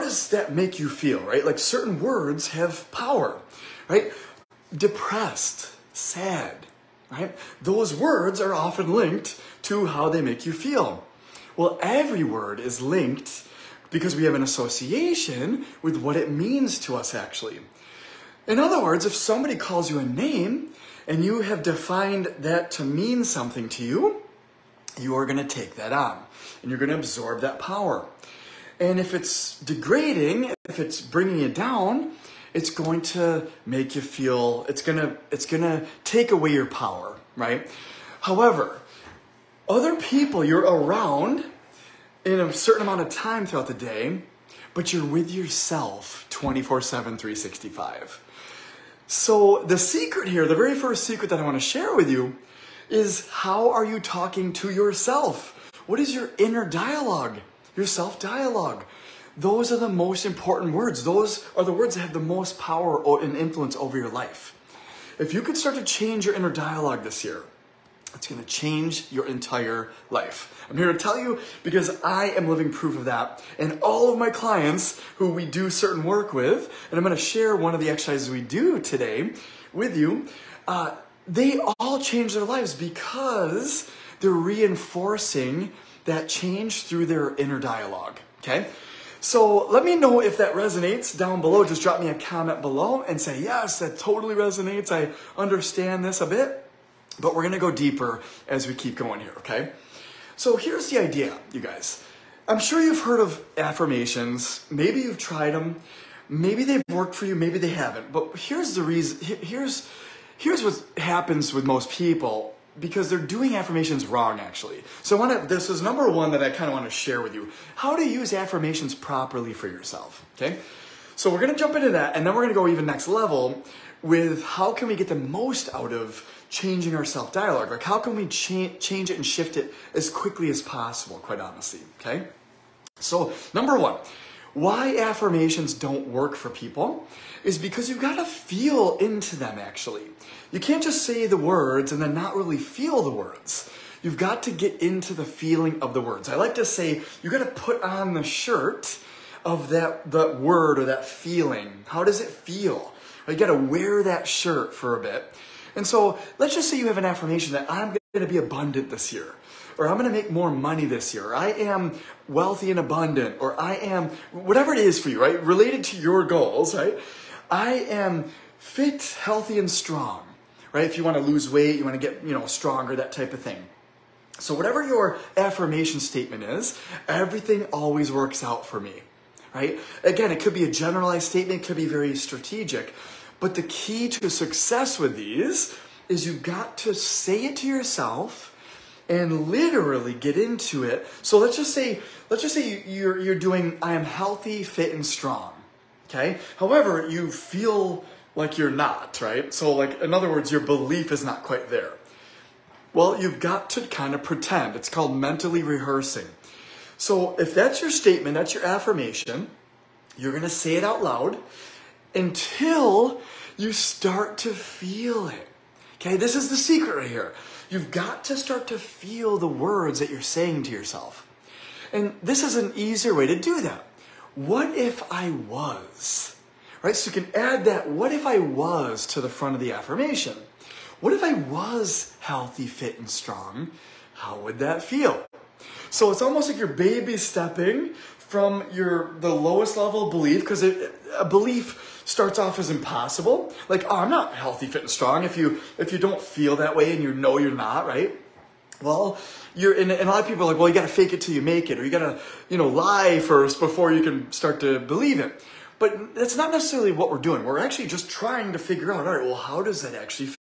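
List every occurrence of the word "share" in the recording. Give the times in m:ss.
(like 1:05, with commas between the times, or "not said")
0:51, 1:17, 1:56.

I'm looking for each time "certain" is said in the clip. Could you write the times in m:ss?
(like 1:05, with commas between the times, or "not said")
0:01, 0:42, 1:15.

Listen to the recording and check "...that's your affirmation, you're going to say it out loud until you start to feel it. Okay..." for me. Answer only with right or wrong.
right.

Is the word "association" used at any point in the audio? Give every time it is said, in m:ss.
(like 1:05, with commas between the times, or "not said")
0:14.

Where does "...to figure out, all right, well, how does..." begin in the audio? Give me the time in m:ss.
4:18.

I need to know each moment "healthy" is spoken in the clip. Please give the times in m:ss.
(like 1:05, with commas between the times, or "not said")
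2:49, 3:14, 3:52, 4:04.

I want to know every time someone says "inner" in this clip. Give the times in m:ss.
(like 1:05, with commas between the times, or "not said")
0:56, 1:06, 1:27.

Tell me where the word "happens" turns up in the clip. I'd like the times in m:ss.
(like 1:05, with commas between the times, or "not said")
1:50.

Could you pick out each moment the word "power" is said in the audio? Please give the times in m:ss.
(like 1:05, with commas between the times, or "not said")
0:02, 0:27, 0:36, 1:02.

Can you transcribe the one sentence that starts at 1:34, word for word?
I understand this a bit, but we're gonna go deeper as we keep going here, okay?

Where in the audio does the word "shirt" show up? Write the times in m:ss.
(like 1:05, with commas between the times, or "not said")
2:28, 2:34.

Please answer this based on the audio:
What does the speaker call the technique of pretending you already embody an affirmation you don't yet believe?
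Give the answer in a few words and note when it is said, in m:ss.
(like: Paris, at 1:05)
mentally rehearsing, at 3:25.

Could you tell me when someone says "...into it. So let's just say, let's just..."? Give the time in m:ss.
3:10.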